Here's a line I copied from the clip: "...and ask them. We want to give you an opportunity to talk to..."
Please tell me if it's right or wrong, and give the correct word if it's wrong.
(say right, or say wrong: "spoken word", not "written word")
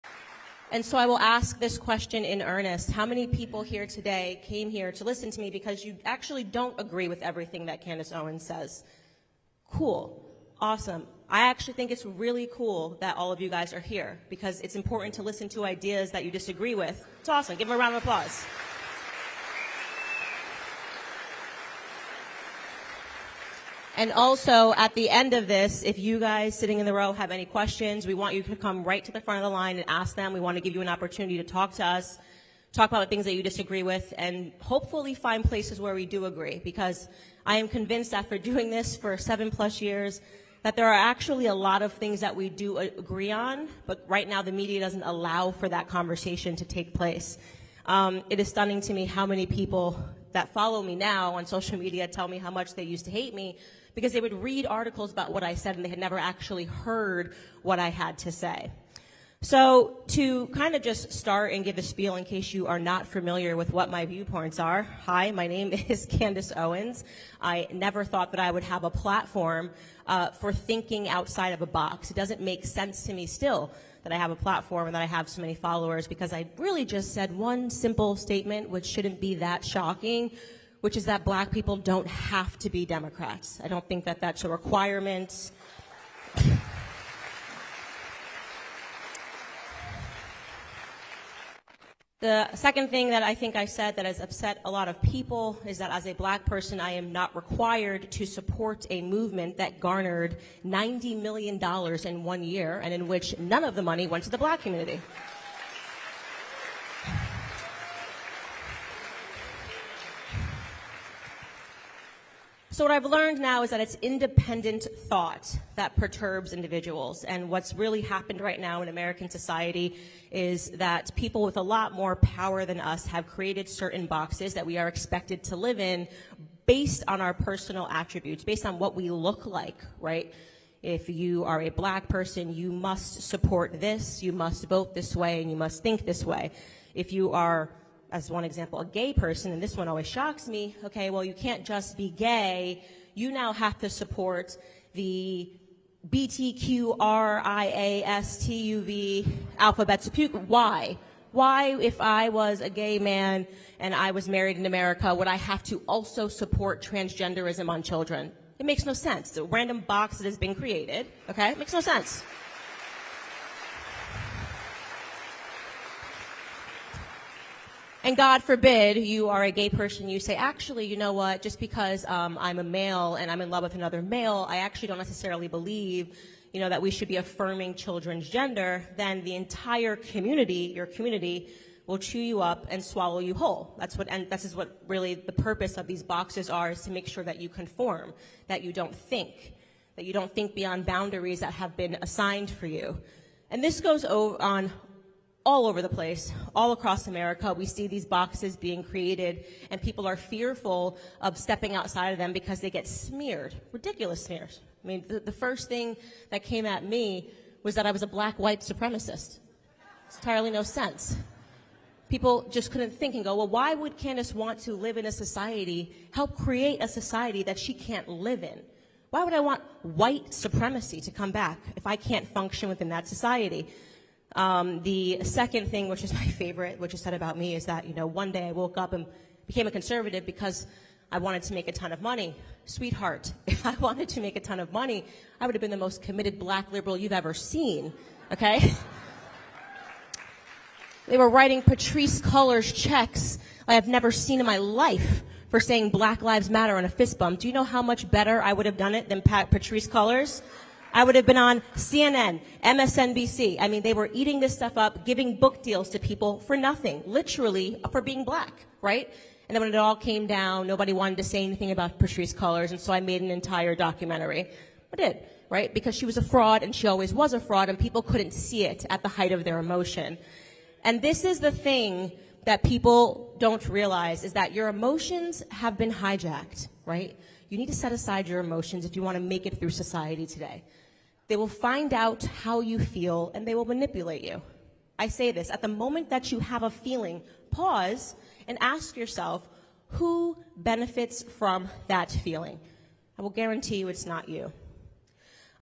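right.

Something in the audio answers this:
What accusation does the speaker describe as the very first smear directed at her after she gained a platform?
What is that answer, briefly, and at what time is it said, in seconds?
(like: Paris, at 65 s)
Black white supremacist, at 208 s.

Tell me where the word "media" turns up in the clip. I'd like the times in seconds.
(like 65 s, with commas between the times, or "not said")
44 s, 51 s.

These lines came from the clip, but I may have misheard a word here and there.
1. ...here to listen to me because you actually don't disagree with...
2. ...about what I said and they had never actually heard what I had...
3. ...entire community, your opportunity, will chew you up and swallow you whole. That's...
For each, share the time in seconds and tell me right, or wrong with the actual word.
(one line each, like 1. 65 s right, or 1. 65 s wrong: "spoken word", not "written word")
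1. 4 s wrong: "agree", not "disagree"
2. 55 s right
3. 179 s wrong: "community", not "opportunity".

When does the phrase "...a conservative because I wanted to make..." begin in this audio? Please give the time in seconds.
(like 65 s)
229 s.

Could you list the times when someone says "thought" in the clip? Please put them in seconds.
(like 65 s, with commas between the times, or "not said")
68 s, 115 s.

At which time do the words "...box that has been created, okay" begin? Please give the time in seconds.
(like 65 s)
159 s.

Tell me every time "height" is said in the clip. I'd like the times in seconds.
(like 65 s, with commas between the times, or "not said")
269 s.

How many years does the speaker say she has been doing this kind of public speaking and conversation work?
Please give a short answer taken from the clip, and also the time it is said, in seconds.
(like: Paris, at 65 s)
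7, at 39 s.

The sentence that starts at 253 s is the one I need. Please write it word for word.
I mean, they were eating this stuff up, giving book deals to people for nothing, literally for being black, right?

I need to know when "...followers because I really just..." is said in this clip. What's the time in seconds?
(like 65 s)
75 s.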